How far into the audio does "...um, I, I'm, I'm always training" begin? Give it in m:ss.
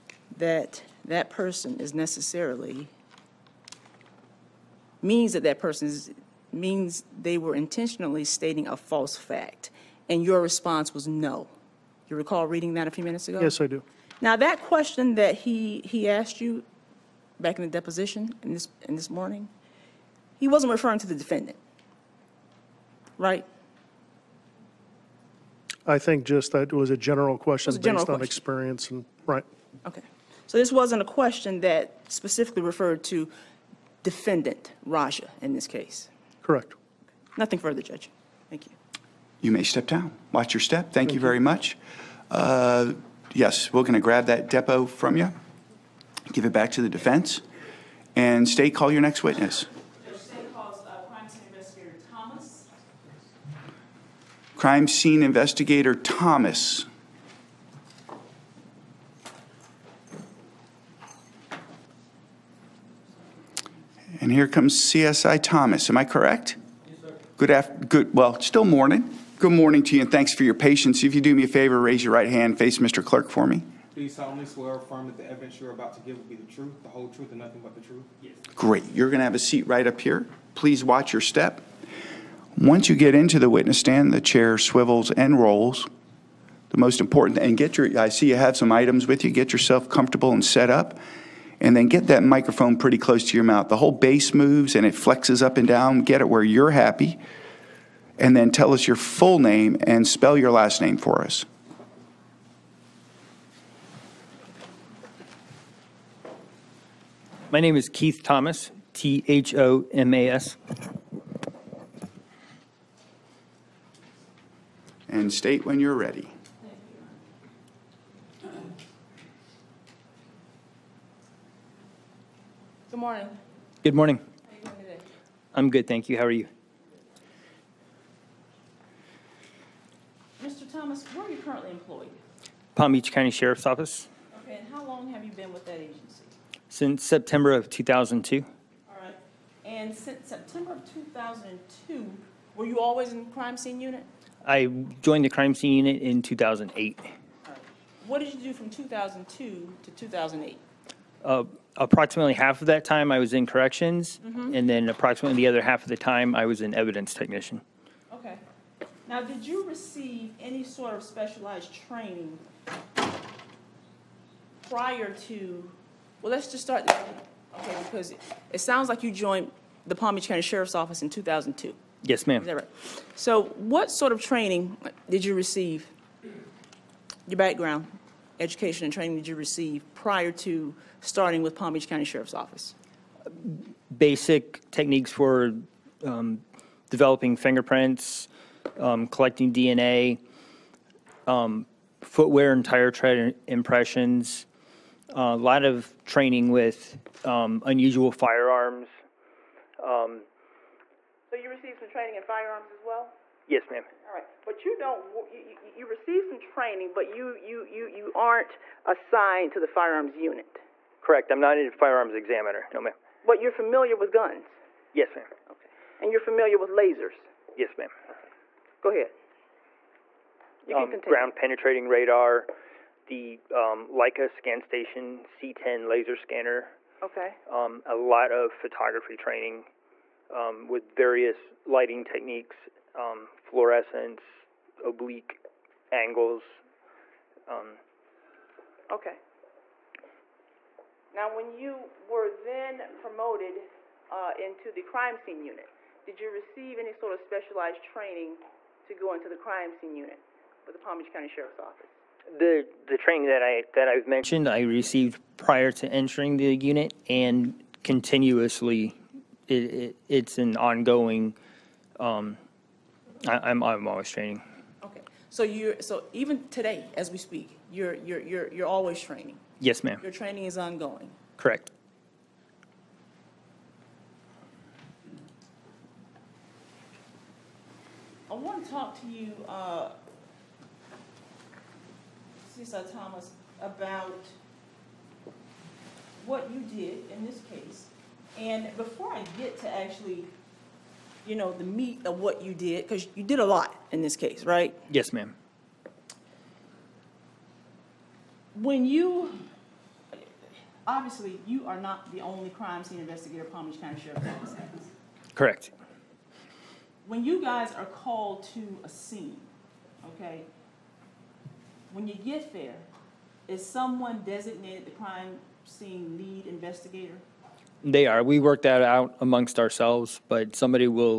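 4:21.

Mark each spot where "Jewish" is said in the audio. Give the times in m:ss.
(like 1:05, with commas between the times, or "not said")
not said.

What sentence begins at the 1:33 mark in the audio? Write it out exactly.
The whole base moves and it flexes up and down.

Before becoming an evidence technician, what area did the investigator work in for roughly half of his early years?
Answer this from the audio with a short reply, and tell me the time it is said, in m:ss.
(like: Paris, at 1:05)
corrections, at 2:33.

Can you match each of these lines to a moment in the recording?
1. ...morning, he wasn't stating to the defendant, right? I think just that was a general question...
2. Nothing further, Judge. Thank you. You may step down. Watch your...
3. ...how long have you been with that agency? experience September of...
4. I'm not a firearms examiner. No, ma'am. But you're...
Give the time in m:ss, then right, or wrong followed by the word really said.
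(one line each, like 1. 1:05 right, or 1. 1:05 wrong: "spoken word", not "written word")
1. 0:19 wrong: "referring", not "stating"
2. 0:37 right
3. 2:14 wrong: "since", not "experience"
4. 3:31 right.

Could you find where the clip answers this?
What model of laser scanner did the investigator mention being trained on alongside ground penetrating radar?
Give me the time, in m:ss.
3:43.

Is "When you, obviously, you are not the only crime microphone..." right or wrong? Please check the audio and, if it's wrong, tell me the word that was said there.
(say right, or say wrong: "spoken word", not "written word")
wrong: "scene", not "microphone".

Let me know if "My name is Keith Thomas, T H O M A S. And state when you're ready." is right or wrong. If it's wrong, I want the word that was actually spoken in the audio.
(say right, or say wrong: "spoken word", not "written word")
right.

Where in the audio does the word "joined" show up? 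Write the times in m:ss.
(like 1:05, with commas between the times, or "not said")
2:25, 2:49.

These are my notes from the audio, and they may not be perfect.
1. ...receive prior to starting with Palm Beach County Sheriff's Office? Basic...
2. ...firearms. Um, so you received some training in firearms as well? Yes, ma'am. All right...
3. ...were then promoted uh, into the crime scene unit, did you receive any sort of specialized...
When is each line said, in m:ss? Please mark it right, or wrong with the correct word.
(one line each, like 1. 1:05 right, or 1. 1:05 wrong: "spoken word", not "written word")
1. 2:59 right
2. 3:18 right
3. 4:02 right.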